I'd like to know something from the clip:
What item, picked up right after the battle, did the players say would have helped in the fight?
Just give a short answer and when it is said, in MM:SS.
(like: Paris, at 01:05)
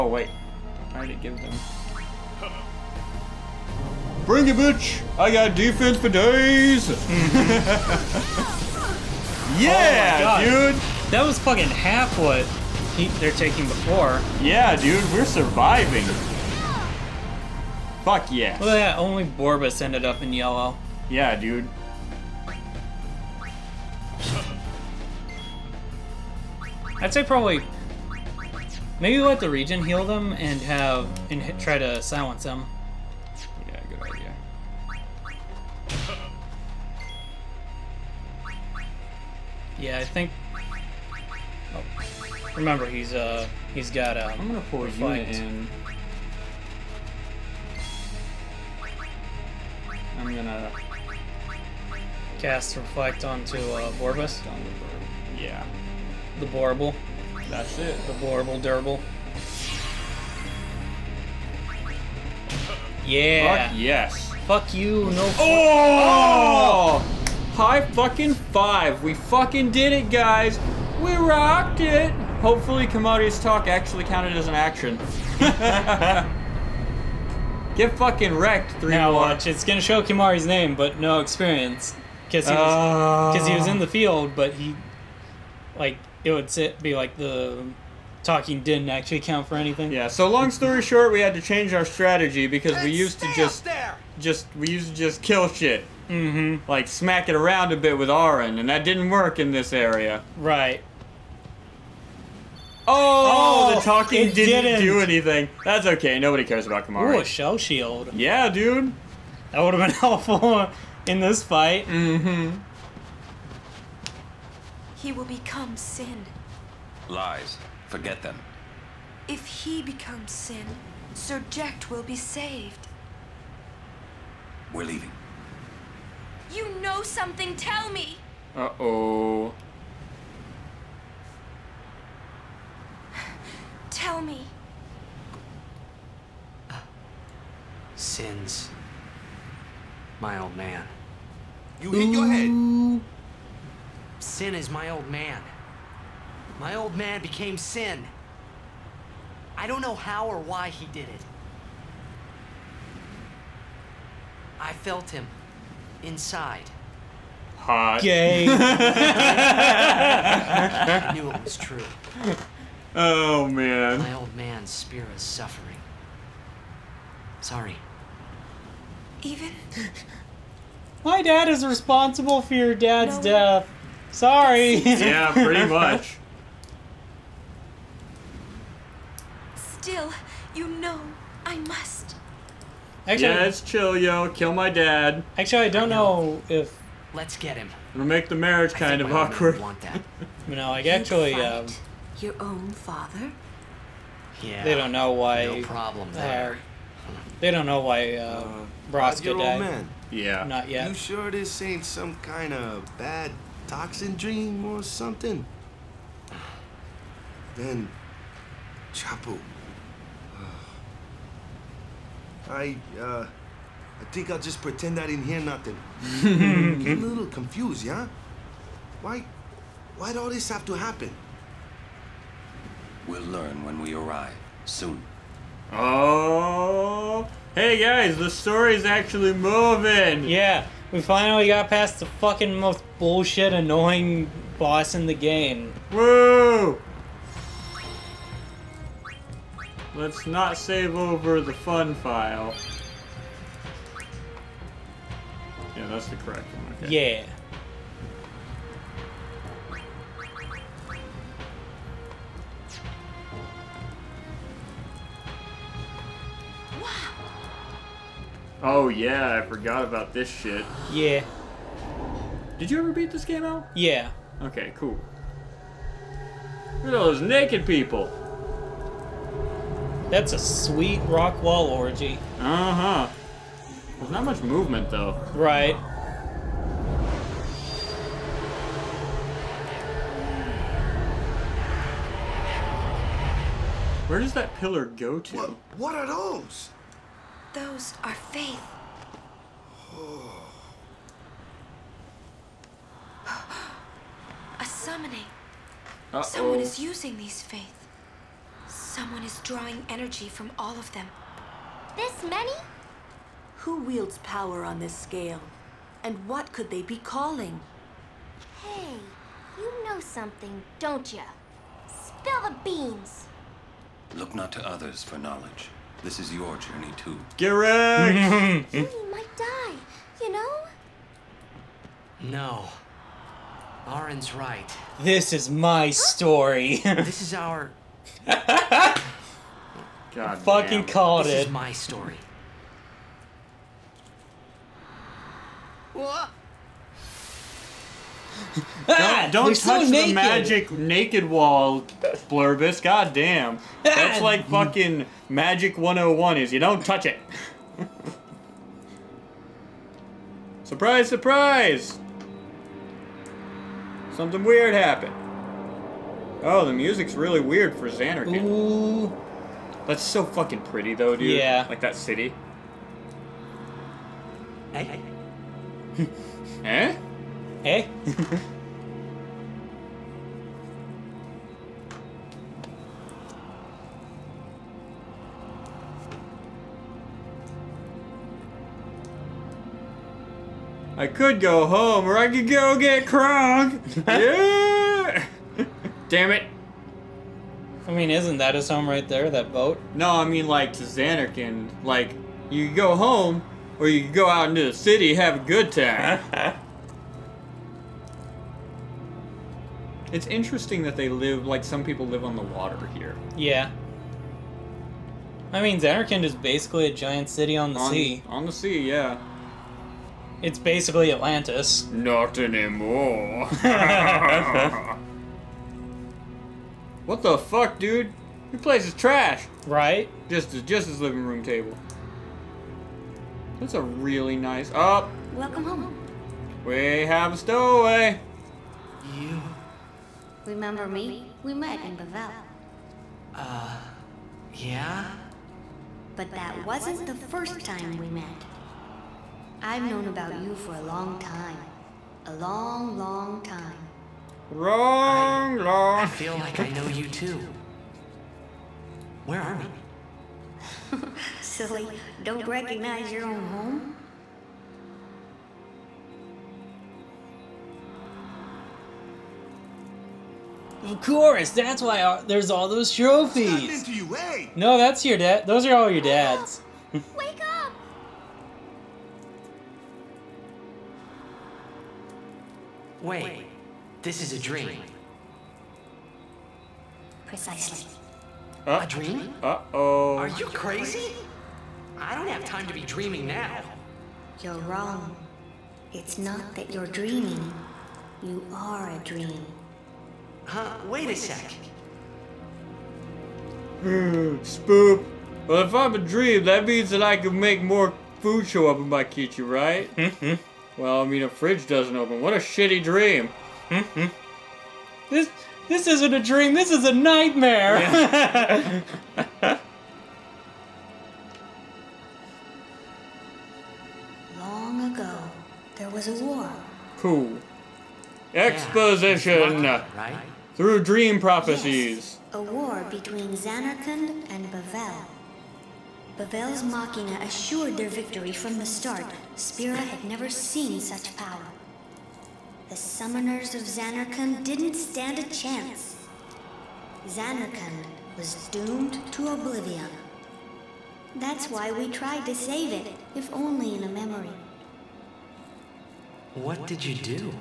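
a shell shield, at 01:47.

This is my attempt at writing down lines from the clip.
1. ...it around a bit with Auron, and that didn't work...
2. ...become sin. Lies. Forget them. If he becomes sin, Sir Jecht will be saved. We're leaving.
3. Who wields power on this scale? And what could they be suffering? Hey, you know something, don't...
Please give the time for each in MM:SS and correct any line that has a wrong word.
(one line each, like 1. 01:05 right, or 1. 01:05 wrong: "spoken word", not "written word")
1. 01:37 right
2. 01:55 right
3. 05:03 wrong: "calling", not "suffering".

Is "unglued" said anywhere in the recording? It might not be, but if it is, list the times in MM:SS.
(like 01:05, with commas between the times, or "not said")
not said.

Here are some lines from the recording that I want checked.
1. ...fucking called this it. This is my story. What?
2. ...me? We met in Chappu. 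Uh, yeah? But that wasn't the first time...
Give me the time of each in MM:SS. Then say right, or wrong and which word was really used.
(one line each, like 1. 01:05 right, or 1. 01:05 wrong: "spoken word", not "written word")
1. 05:30 right
2. 07:10 wrong: "Bevelle", not "Chappu".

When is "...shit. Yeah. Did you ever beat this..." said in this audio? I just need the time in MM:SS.
04:20.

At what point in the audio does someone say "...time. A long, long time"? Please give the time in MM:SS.
07:21.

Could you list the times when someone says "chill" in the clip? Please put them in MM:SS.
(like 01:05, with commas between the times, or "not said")
03:03.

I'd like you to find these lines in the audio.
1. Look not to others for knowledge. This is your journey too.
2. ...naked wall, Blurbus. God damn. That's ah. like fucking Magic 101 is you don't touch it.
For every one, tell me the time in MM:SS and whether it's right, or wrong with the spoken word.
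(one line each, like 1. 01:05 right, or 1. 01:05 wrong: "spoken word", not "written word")
1. 05:14 right
2. 05:40 right.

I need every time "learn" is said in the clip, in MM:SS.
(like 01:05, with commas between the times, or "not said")
03:43.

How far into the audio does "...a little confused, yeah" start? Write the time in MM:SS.
03:37.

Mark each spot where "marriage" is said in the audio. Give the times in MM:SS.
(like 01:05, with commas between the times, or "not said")
03:08.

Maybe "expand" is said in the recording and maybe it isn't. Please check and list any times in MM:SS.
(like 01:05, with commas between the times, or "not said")
not said.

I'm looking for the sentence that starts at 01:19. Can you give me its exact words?
watch, it's gonna show Kimahri's name, but no experience.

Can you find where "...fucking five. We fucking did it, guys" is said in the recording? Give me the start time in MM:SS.
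01:07.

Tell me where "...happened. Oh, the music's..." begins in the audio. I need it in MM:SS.
05:54.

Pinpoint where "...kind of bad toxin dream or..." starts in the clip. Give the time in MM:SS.
03:22.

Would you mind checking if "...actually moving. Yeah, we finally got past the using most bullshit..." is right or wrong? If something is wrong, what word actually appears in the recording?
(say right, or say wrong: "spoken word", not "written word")
wrong: "fucking", not "using".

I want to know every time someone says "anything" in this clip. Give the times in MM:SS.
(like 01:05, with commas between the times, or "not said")
01:29, 01:45.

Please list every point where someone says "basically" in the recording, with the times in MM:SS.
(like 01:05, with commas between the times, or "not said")
06:46, 06:50.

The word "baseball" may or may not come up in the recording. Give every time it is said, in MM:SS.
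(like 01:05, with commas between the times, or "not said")
not said.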